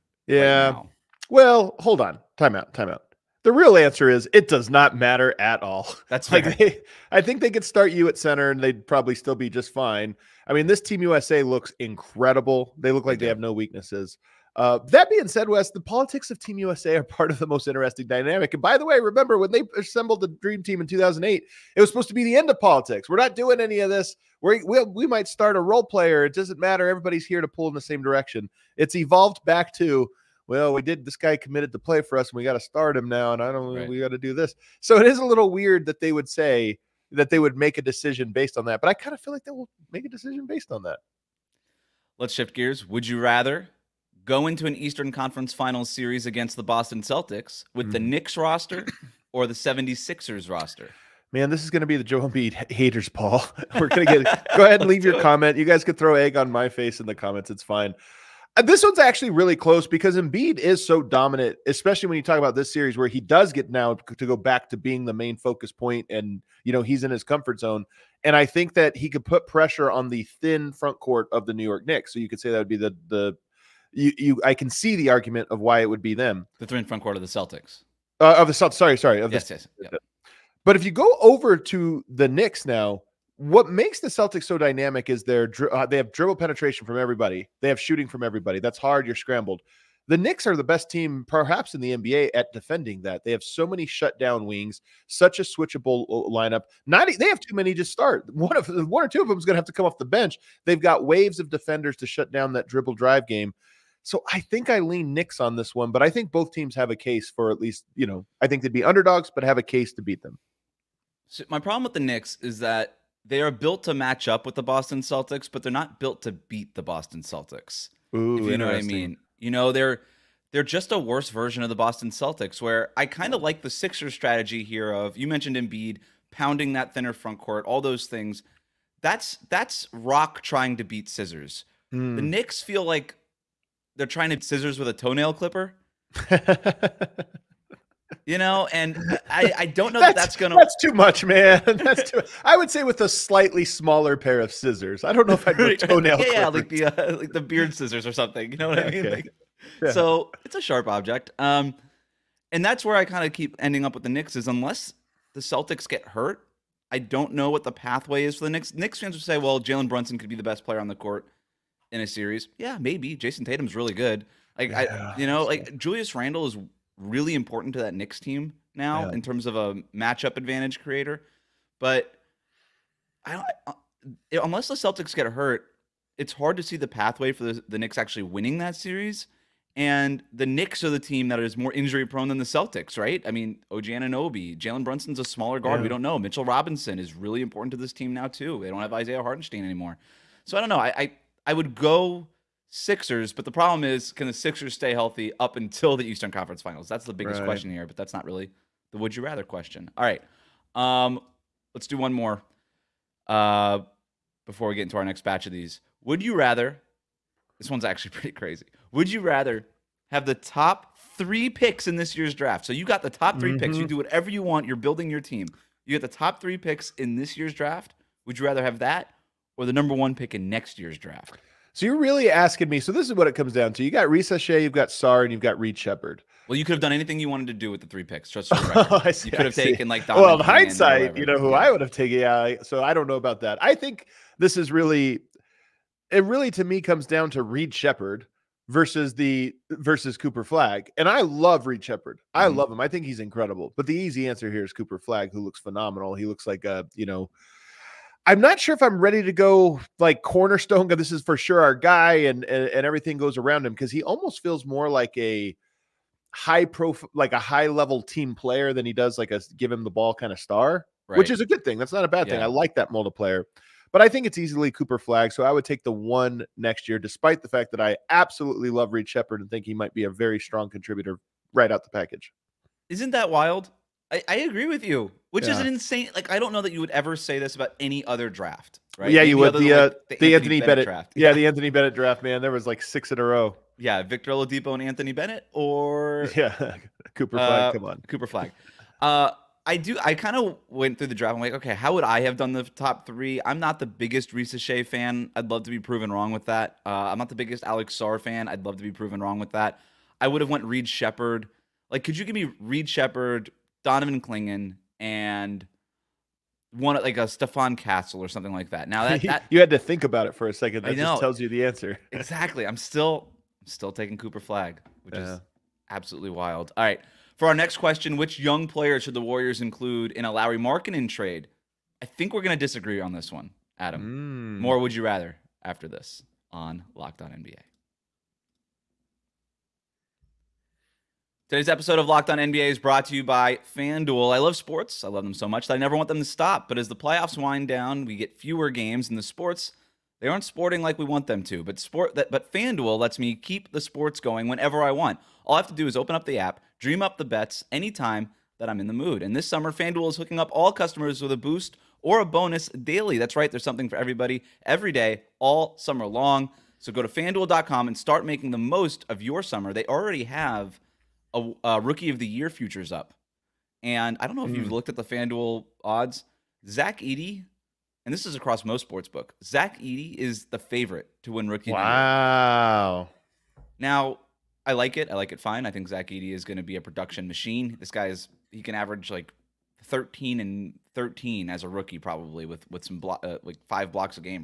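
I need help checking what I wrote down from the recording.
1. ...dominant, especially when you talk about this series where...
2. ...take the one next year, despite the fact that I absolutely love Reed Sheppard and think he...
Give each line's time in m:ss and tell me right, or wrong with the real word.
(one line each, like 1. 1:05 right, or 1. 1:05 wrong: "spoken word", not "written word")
1. 1:01 right
2. 4:25 right.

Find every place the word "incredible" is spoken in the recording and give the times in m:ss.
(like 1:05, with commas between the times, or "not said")
0:11, 4:03.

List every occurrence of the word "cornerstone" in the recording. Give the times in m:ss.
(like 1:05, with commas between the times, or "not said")
4:10.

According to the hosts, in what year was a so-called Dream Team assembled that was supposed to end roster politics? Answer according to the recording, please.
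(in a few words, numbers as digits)
2008.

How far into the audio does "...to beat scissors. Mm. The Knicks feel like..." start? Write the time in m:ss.
2:10.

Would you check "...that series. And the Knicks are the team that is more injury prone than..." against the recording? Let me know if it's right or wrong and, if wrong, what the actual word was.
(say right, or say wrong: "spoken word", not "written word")
right.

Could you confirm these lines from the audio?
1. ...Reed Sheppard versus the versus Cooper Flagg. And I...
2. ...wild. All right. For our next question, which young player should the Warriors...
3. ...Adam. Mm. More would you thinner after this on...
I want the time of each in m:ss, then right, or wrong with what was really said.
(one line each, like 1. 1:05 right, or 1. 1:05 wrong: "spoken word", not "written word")
1. 3:57 right
2. 5:16 right
3. 5:23 wrong: "rather", not "thinner".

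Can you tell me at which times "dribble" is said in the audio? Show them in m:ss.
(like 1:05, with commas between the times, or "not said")
1:26, 1:42.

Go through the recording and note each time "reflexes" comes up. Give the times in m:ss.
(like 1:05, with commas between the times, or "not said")
not said.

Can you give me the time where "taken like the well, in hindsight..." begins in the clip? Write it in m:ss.
3:49.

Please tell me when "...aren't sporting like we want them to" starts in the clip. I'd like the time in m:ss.
5:40.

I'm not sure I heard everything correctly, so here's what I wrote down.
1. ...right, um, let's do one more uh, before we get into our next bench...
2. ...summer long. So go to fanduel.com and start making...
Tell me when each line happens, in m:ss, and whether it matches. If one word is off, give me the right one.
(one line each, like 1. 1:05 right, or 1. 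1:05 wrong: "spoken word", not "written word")
1. 3:20 wrong: "batch", not "bench"
2. 5:55 right.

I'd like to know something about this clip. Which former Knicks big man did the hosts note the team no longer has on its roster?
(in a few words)
Isaiah Hartenstein.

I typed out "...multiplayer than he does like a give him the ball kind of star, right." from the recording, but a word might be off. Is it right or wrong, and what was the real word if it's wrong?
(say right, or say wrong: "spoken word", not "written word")
wrong: "player", not "multiplayer".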